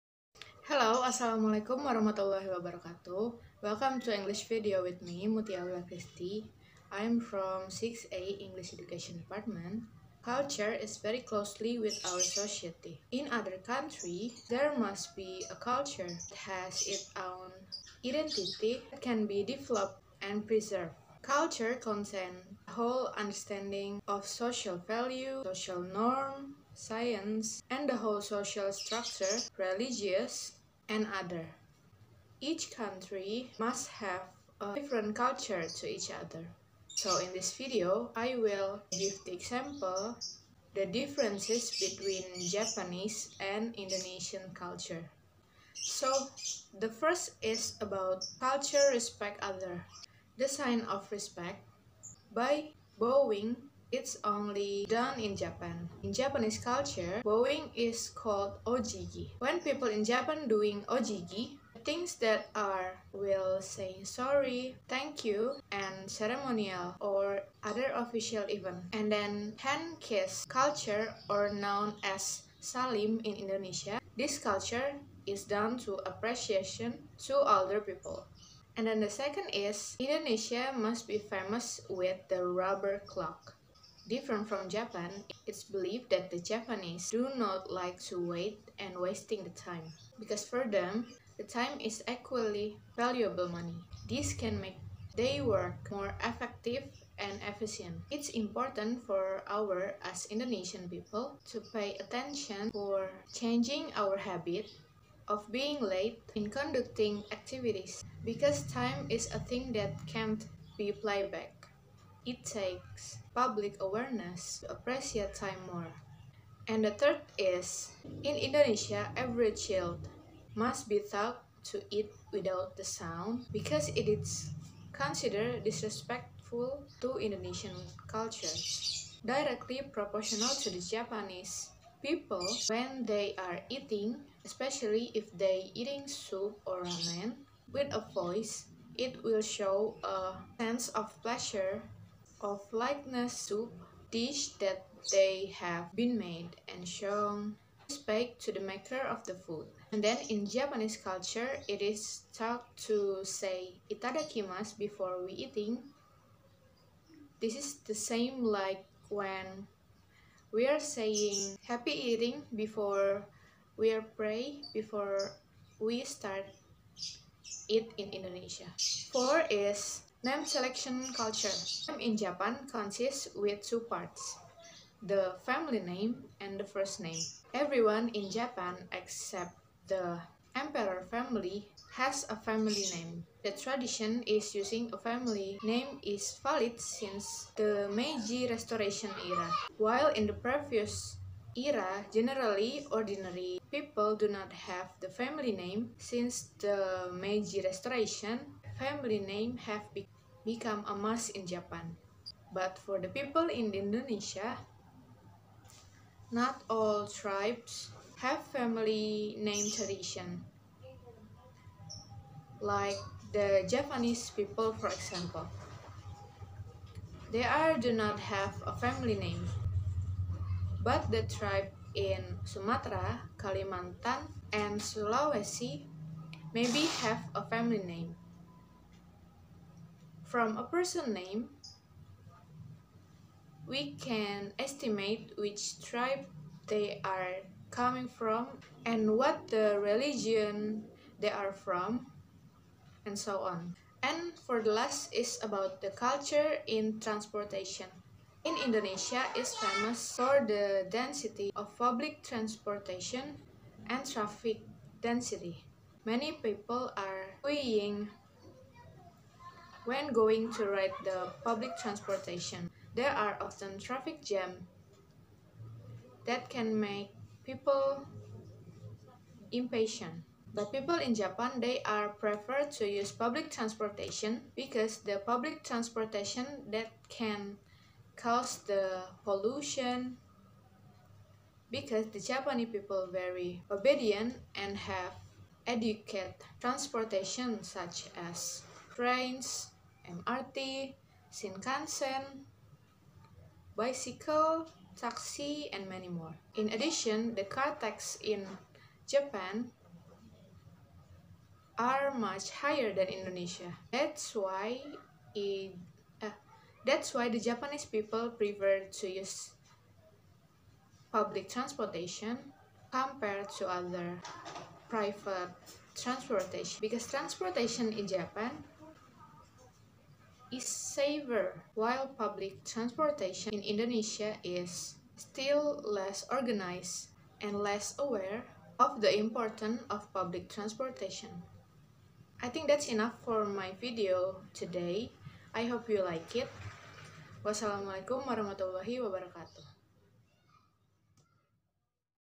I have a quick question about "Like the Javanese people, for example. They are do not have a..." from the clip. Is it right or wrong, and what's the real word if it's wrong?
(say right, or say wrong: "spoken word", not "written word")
right.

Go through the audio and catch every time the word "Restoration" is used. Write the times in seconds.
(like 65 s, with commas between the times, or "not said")
188 s, 197 s.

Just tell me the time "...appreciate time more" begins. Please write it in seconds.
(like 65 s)
114 s.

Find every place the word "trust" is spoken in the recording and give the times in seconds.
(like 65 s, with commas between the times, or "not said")
not said.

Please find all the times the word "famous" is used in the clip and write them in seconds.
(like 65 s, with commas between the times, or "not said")
81 s, 249 s.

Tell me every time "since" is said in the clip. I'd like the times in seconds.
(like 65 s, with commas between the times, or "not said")
186 s, 195 s.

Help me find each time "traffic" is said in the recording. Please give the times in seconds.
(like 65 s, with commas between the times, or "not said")
254 s, 263 s.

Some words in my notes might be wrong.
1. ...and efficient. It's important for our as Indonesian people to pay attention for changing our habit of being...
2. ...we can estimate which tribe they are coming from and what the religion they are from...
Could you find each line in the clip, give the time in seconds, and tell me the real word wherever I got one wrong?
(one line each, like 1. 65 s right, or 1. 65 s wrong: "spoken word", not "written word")
1. 97 s right
2. 233 s right.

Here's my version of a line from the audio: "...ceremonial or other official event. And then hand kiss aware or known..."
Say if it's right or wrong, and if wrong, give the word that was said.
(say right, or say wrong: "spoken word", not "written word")
wrong: "culture", not "aware".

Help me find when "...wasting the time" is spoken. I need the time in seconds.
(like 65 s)
88 s.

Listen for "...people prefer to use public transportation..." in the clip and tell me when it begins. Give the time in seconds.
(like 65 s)
307 s.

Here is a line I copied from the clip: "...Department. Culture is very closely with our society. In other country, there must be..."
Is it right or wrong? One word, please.
right.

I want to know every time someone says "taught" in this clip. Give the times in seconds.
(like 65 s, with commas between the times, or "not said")
121 s, 152 s.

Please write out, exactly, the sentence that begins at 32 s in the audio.
Each country must have a different culture to each other.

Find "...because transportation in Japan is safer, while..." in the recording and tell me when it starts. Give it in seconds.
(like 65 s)
316 s.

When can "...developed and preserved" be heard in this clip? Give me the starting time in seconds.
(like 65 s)
19 s.